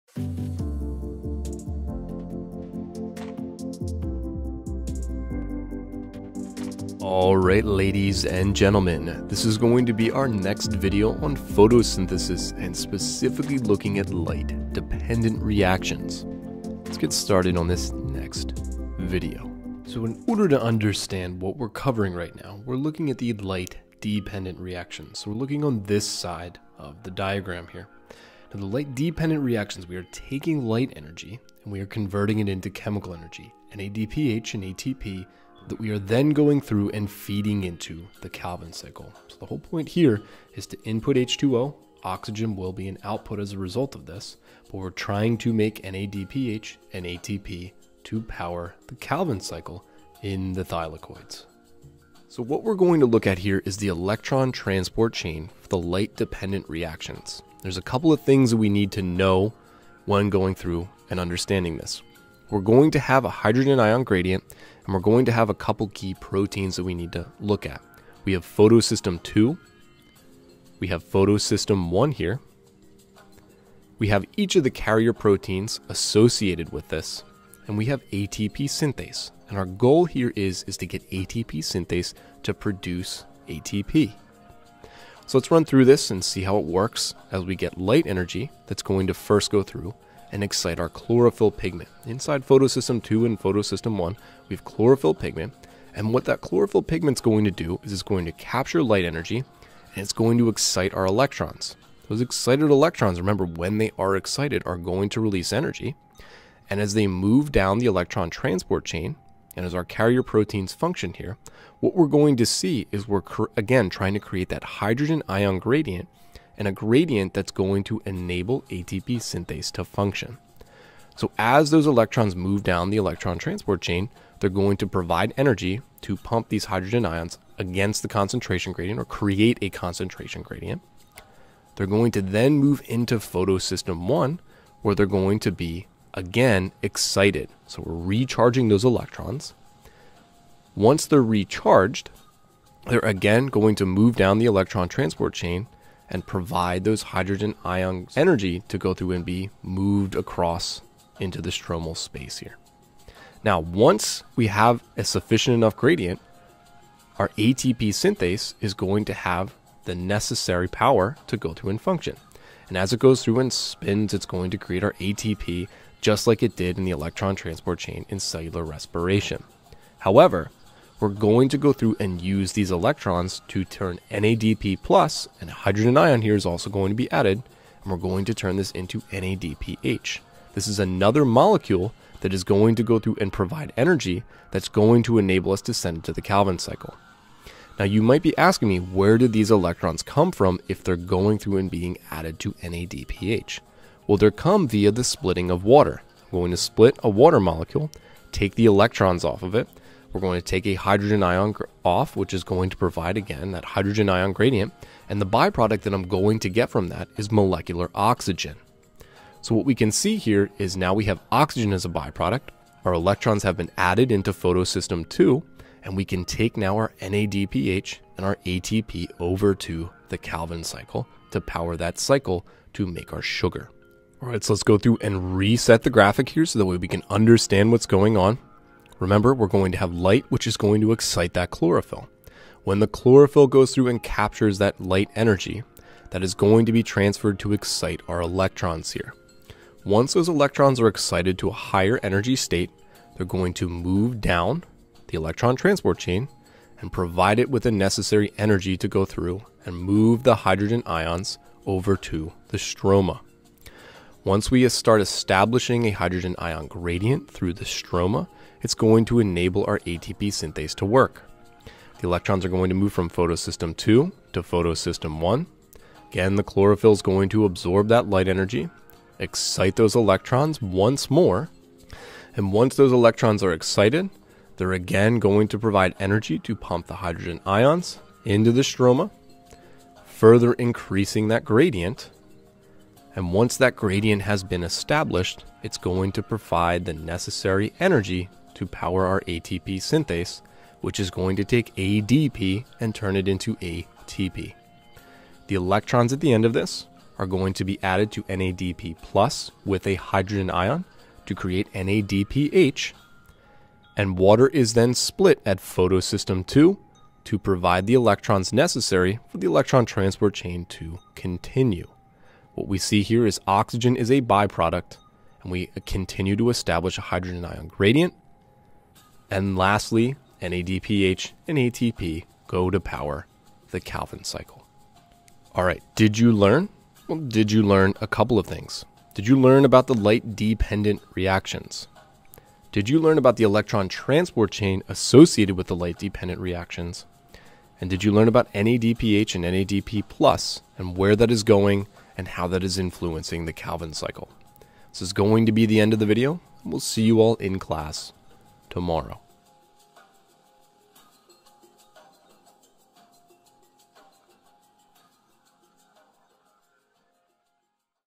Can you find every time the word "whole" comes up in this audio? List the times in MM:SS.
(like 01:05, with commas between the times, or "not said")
00:39.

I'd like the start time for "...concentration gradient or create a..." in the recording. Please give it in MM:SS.
02:08.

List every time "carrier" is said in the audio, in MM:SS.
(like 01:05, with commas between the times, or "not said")
01:14, 01:49.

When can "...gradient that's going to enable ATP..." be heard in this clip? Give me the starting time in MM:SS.
01:56.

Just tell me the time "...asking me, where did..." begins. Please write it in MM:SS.
03:08.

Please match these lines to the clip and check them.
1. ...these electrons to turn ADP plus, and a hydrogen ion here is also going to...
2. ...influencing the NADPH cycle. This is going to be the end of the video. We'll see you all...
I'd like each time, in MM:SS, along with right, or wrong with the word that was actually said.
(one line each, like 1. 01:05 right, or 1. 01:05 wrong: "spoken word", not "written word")
1. 02:52 wrong: "NADP", not "ADP"
2. 05:42 wrong: "Calvin", not "NADPH".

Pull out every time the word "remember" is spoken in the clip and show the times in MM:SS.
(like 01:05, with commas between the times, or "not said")
01:43, 03:49.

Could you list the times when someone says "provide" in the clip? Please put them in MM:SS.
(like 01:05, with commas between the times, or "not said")
02:04, 02:26, 03:03, 03:22, 04:06, 04:35, 04:46, 05:07.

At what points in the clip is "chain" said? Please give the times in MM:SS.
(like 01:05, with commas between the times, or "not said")
00:55, 01:48, 02:03, 02:25, 02:47, 04:05, 05:10, 05:34.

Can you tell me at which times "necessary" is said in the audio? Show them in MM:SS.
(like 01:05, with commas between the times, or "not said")
02:39, 04:07, 04:46, 05:08.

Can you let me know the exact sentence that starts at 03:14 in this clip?
Well, they come via the splitting of water.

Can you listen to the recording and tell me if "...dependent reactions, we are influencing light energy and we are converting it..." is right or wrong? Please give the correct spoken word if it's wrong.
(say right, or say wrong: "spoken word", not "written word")
wrong: "taking", not "influencing".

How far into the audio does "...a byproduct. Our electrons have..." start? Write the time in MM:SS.
03:31.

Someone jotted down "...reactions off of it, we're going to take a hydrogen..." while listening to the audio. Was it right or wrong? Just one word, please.
wrong.